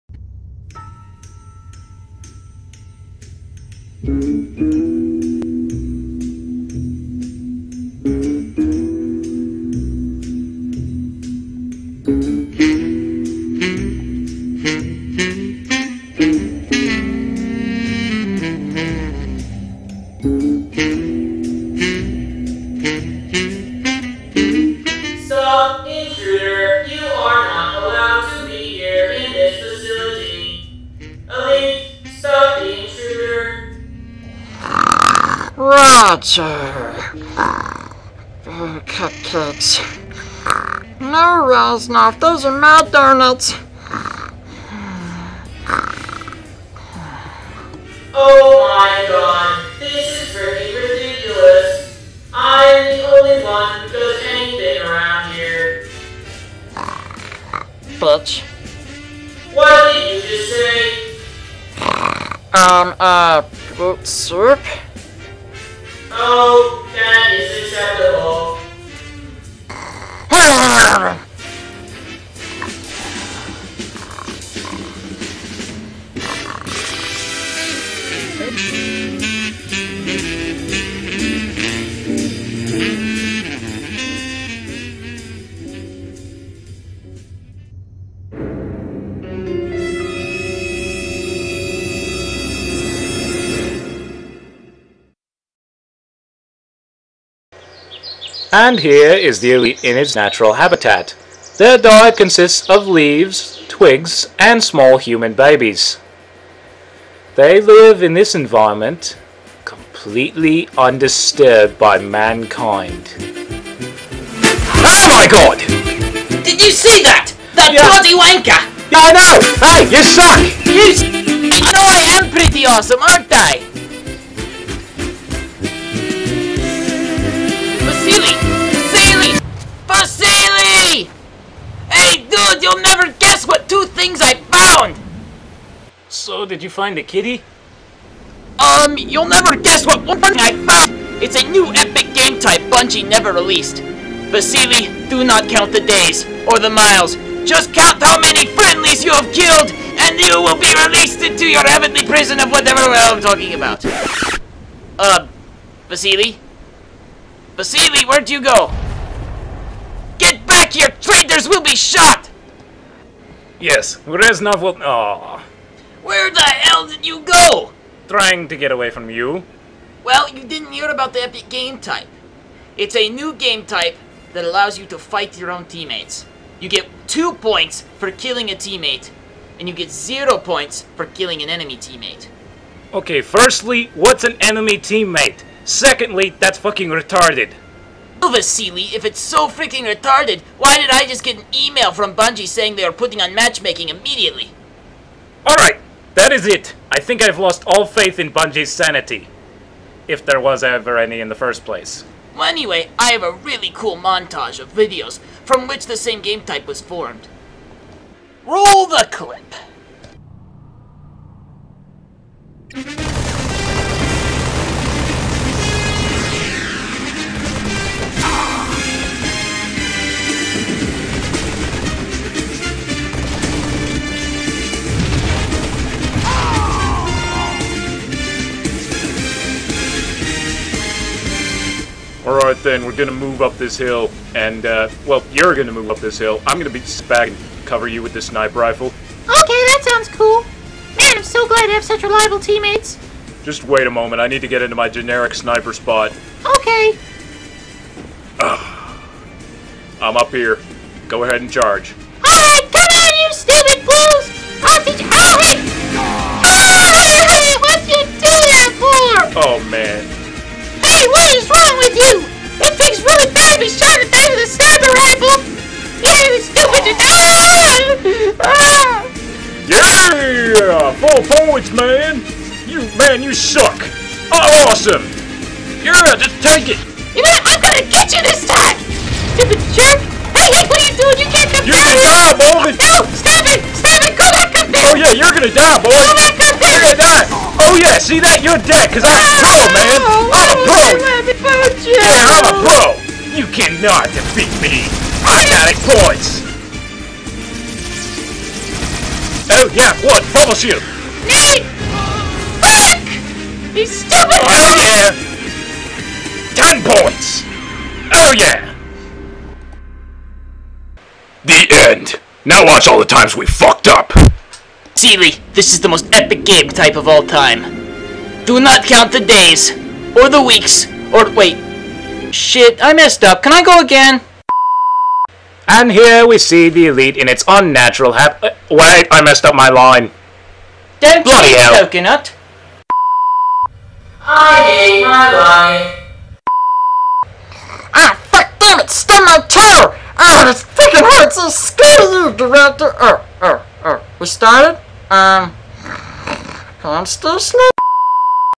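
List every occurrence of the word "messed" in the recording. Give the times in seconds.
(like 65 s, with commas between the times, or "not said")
322 s, 329 s.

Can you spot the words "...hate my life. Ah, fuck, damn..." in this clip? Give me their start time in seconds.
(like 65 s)
334 s.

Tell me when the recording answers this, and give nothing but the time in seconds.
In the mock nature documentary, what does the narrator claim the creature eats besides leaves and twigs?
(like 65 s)
104 s.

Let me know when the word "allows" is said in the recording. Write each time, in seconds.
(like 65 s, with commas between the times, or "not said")
174 s.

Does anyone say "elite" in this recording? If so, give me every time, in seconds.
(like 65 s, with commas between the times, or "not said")
99 s, 326 s.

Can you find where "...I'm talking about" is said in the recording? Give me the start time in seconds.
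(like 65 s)
152 s.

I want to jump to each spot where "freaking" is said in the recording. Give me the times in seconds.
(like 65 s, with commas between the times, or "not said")
189 s.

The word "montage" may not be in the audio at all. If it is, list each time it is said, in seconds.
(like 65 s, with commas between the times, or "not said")
203 s.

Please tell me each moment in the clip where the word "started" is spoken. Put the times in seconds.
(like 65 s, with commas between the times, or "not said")
344 s.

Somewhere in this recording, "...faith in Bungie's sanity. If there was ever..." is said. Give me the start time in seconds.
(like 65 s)
197 s.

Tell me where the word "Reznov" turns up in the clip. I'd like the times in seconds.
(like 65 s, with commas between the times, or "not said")
41 s, 164 s.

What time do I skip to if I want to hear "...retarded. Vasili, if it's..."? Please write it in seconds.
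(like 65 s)
186 s.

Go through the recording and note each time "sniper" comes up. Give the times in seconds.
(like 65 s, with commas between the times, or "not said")
238 s, 245 s.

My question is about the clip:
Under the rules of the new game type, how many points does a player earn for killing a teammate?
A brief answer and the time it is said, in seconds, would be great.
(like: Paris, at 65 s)
2, at 177 s.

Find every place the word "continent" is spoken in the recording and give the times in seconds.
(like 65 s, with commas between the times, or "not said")
not said.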